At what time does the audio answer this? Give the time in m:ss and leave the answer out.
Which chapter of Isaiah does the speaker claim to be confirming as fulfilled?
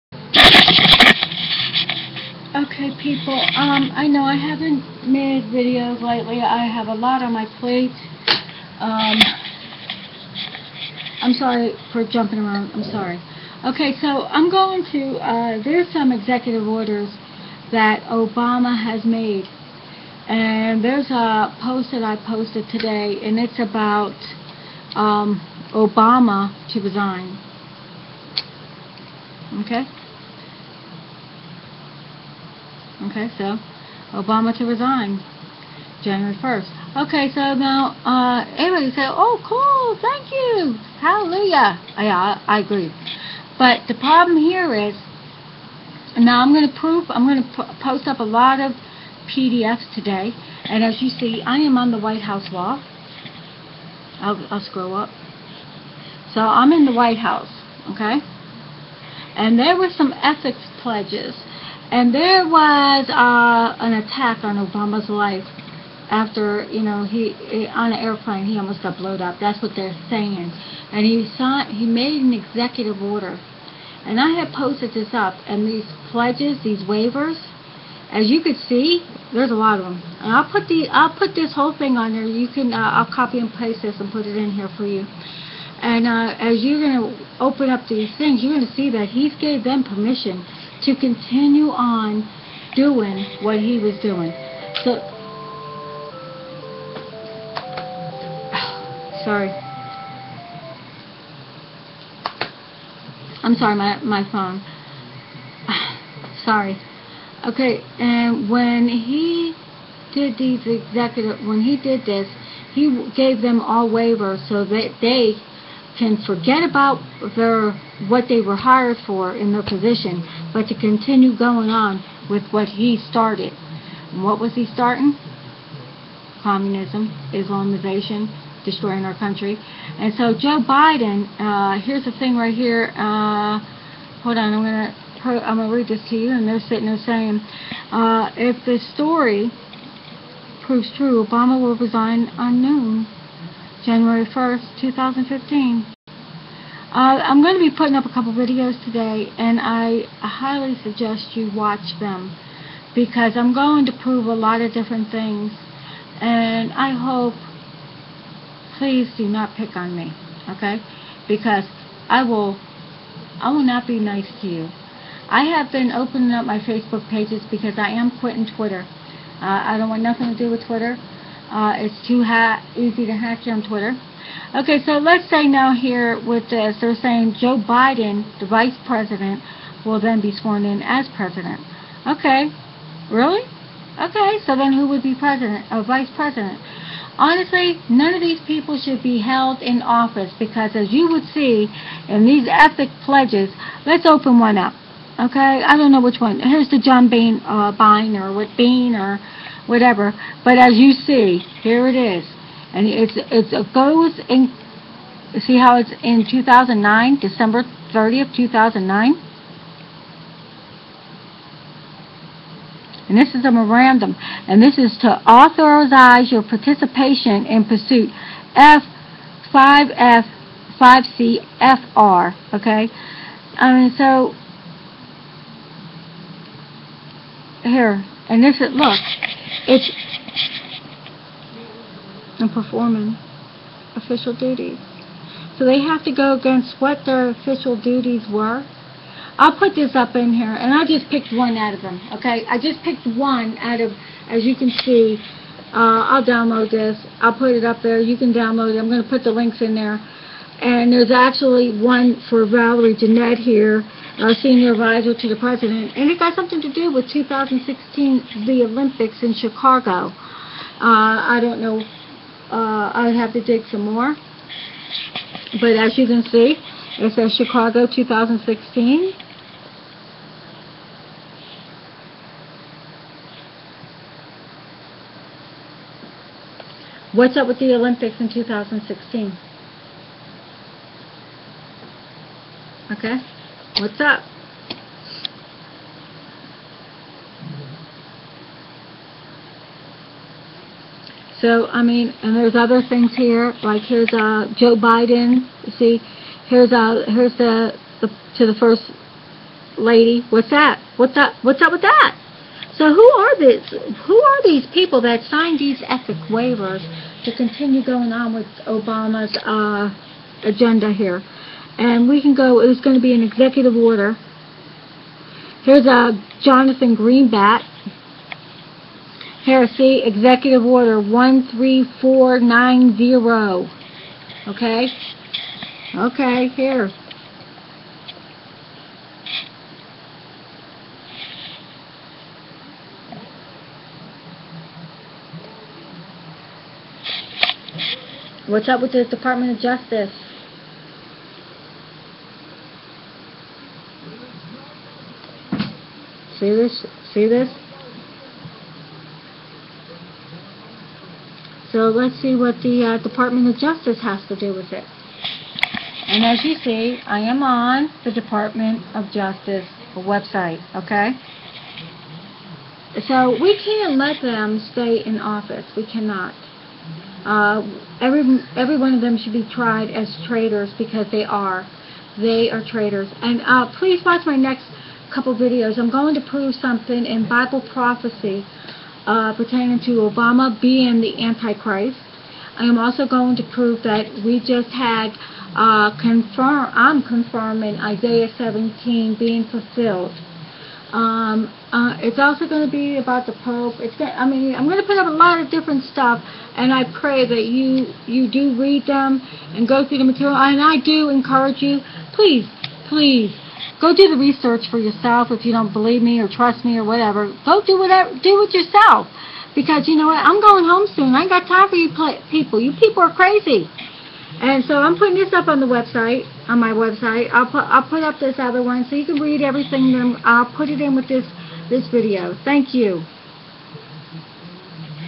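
6:27.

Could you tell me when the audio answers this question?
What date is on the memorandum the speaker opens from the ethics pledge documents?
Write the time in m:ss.
3:27.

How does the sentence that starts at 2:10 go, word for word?
And so Joe Biden, uh, here's the thing right here.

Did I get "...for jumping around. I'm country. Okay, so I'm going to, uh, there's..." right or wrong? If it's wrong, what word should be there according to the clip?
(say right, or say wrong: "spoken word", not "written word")
wrong: "sorry", not "country".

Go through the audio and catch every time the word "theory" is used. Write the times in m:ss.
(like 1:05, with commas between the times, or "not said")
not said.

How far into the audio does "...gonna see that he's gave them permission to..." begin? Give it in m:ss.
1:28.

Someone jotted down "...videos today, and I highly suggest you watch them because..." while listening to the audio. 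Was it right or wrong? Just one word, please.
right.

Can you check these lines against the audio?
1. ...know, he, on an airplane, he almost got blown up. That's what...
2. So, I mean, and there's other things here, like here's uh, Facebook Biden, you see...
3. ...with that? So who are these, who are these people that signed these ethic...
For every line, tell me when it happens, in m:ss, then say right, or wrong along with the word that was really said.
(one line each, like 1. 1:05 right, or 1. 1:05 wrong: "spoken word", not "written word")
1. 1:06 right
2. 4:51 wrong: "Joe", not "Facebook"
3. 5:01 right.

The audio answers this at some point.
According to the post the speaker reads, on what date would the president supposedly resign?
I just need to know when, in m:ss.
2:23.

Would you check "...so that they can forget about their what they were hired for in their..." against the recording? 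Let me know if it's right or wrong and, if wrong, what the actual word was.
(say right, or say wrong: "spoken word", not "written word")
right.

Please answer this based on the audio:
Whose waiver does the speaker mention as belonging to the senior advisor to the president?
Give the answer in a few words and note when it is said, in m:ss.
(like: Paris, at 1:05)
Valerie Jarrett, at 4:12.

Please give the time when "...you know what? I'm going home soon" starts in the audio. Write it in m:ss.
6:49.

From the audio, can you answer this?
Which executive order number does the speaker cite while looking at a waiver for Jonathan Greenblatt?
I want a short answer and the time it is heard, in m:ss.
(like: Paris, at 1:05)
13490, at 5:20.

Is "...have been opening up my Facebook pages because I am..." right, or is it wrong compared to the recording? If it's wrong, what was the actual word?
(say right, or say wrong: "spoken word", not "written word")
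right.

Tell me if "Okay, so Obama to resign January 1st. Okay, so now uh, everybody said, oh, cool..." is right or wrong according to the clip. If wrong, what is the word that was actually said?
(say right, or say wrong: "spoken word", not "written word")
right.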